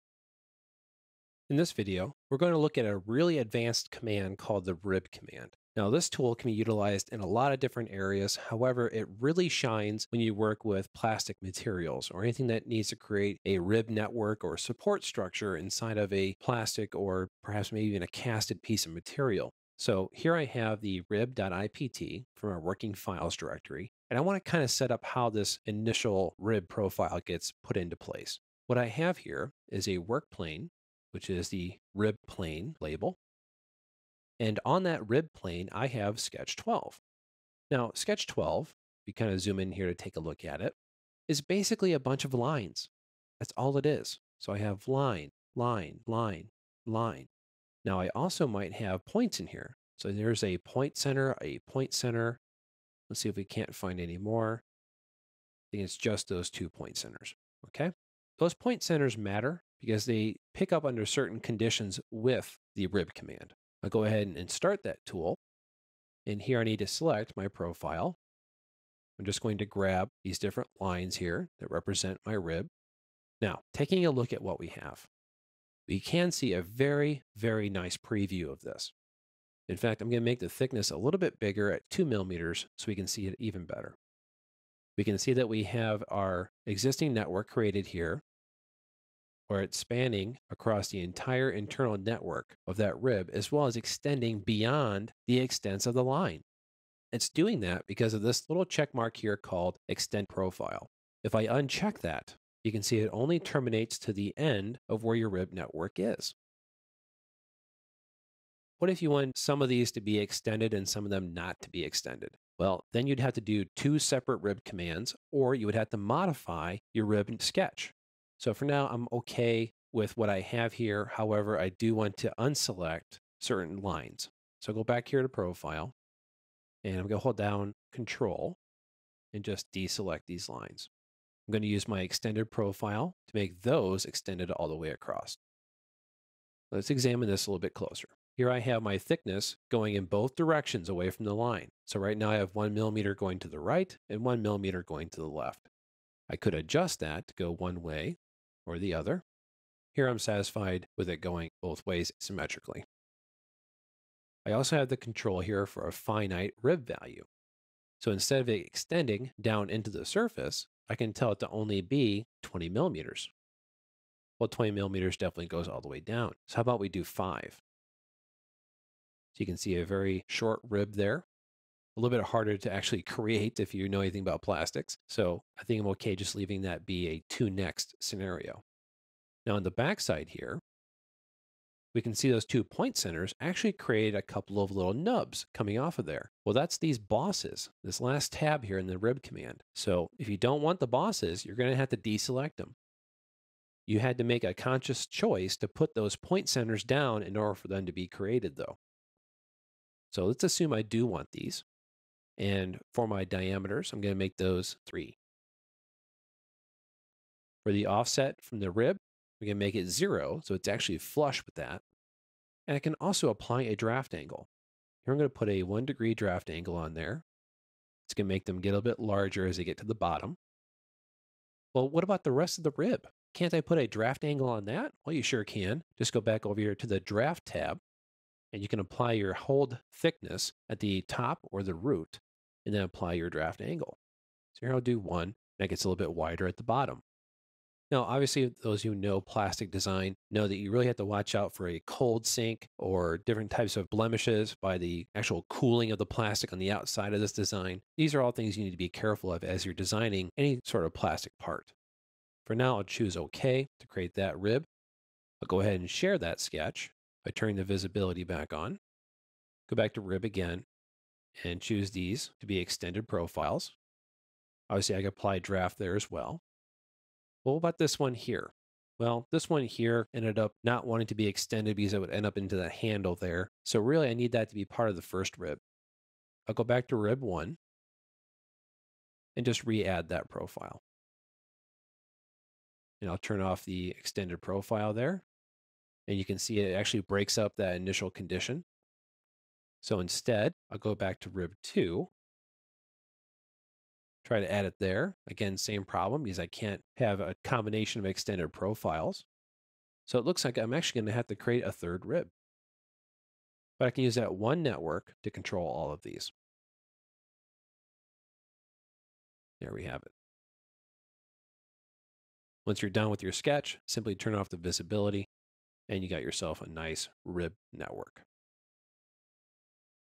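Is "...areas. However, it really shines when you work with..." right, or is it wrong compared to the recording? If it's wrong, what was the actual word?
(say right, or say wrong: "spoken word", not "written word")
right.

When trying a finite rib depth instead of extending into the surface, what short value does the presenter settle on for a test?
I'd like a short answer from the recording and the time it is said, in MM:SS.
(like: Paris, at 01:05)
5, at 02:47.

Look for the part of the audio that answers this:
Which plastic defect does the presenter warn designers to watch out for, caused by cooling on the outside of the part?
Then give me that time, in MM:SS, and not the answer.
04:01.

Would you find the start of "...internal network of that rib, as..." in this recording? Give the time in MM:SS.
01:31.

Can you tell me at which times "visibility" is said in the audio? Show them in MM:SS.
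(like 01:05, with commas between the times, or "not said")
04:17, 05:14.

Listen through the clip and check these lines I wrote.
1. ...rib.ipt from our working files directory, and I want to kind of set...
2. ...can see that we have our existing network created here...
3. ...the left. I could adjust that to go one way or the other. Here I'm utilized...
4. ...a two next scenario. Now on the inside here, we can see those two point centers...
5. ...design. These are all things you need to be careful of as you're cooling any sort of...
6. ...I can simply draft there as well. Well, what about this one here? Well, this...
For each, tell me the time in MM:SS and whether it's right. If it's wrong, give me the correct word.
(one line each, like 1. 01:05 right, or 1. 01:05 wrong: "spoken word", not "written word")
1. 00:21 right
2. 01:25 right
3. 02:25 wrong: "satisfied", not "utilized"
4. 02:57 wrong: "backside", not "inside"
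5. 04:07 wrong: "designing", not "cooling"
6. 04:24 wrong: "apply", not "simply".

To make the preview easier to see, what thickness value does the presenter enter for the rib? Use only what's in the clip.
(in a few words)
2 millimeters.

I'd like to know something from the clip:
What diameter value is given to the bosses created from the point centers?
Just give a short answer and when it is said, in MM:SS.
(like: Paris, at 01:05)
3, at 03:24.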